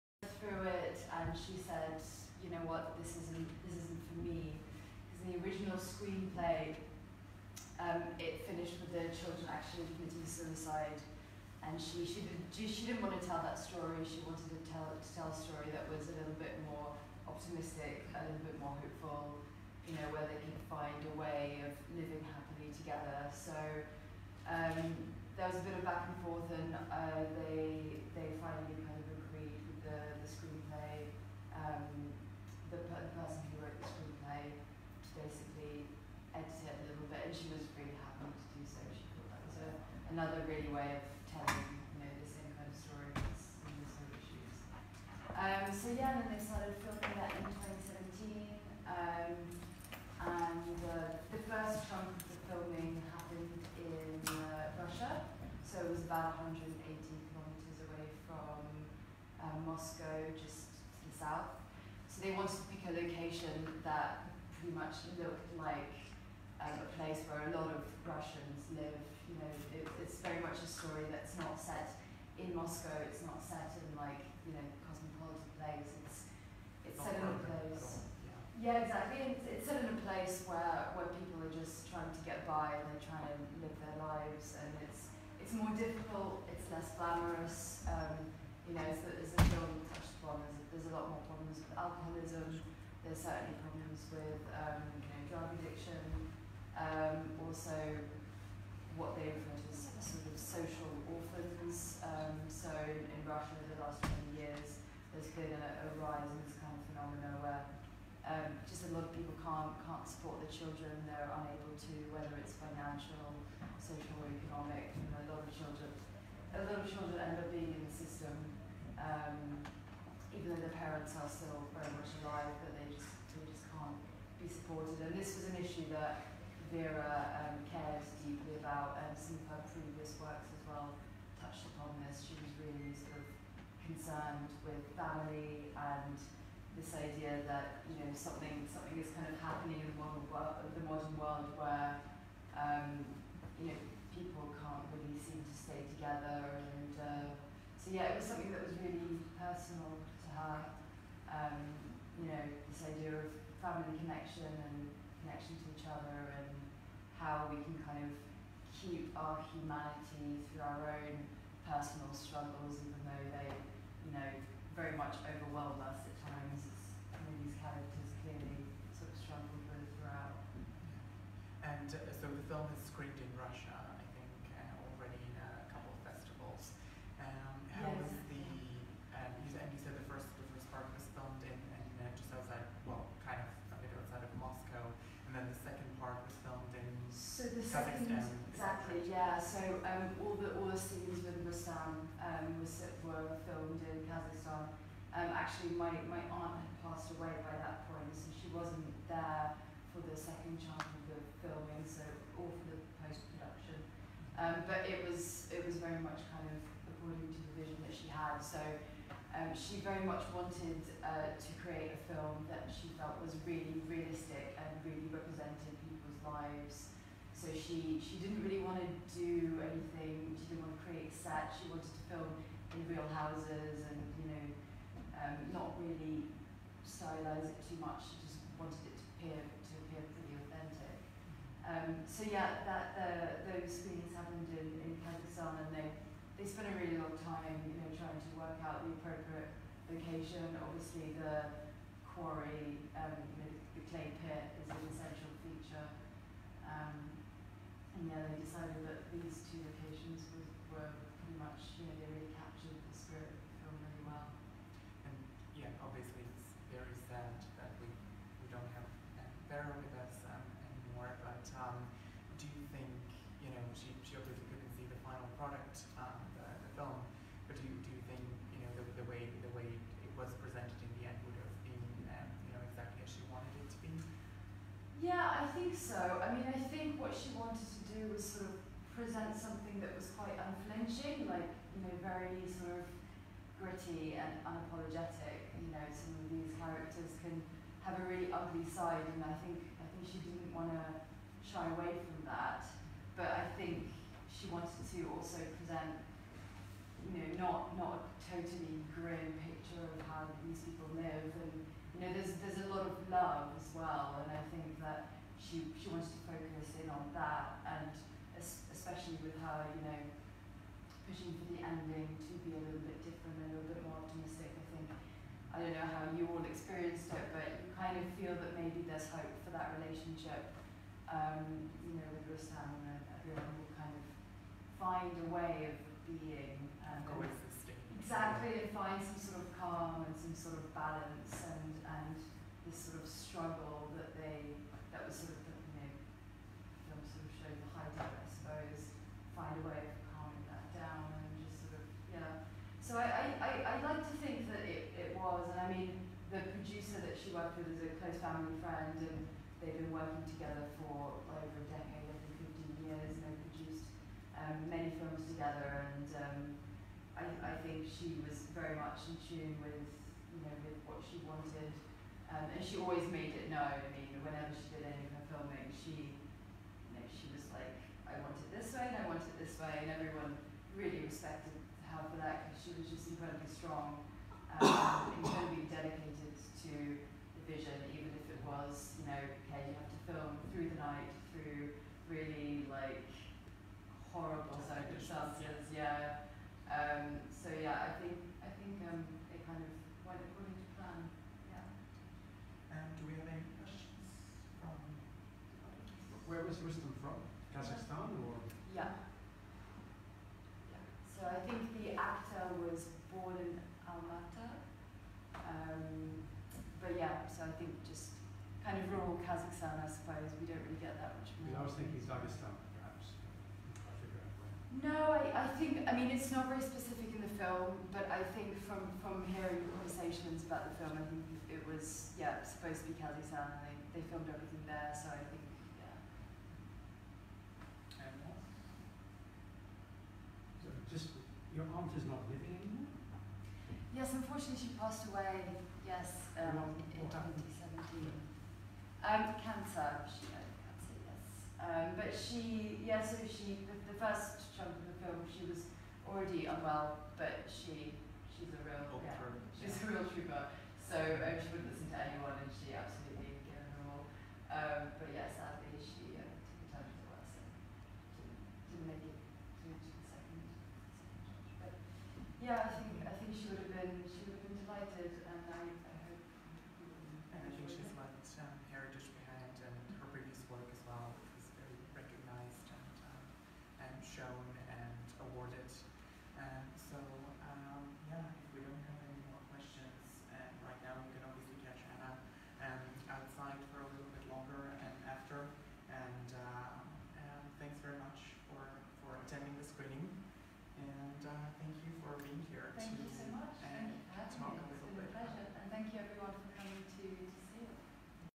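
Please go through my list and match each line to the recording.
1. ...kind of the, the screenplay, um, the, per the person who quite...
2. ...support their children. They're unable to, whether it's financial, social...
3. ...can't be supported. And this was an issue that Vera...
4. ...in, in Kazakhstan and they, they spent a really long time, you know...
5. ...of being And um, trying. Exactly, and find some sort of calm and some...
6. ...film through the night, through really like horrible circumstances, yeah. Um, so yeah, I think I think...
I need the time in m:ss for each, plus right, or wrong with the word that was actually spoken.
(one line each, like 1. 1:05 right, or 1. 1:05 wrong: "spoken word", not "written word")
1. 0:28 wrong: "wrote", not "quite"
2. 1:50 right
3. 2:03 right
4. 3:54 right
5. 5:25 wrong: "coexisting", not "trying"
6. 6:20 right.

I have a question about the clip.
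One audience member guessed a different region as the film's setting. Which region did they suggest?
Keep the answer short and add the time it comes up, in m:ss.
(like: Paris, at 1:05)
Dagestan, at 6:52.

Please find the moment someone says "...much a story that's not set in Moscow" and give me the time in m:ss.
1:10.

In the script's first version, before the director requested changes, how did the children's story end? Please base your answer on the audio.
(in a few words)
Committing suicide.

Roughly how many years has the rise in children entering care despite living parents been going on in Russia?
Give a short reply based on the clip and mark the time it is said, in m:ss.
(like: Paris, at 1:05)
20 years, at 1:44.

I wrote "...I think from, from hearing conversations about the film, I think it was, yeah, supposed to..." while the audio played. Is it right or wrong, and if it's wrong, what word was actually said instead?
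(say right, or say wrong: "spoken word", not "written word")
right.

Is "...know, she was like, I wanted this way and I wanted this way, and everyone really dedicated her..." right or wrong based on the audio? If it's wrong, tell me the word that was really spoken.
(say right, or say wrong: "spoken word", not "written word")
wrong: "respected", not "dedicated".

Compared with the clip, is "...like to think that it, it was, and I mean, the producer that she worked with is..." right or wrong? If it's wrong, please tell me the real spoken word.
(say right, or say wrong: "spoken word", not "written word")
right.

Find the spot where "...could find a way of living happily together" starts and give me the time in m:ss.
0:20.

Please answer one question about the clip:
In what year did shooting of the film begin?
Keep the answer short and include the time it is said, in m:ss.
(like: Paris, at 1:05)
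2017, at 0:47.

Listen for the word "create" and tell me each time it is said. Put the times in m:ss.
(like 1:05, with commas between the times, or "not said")
3:31, 3:40.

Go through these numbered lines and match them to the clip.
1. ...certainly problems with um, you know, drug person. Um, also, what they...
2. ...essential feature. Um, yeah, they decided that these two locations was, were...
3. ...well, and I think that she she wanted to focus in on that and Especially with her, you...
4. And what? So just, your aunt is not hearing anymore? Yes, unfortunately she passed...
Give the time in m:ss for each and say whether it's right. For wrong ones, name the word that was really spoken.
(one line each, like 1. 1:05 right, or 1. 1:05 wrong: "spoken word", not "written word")
1. 1:33 wrong: "addiction", not "person"
2. 4:04 right
3. 5:03 right
4. 7:08 wrong: "living", not "hearing".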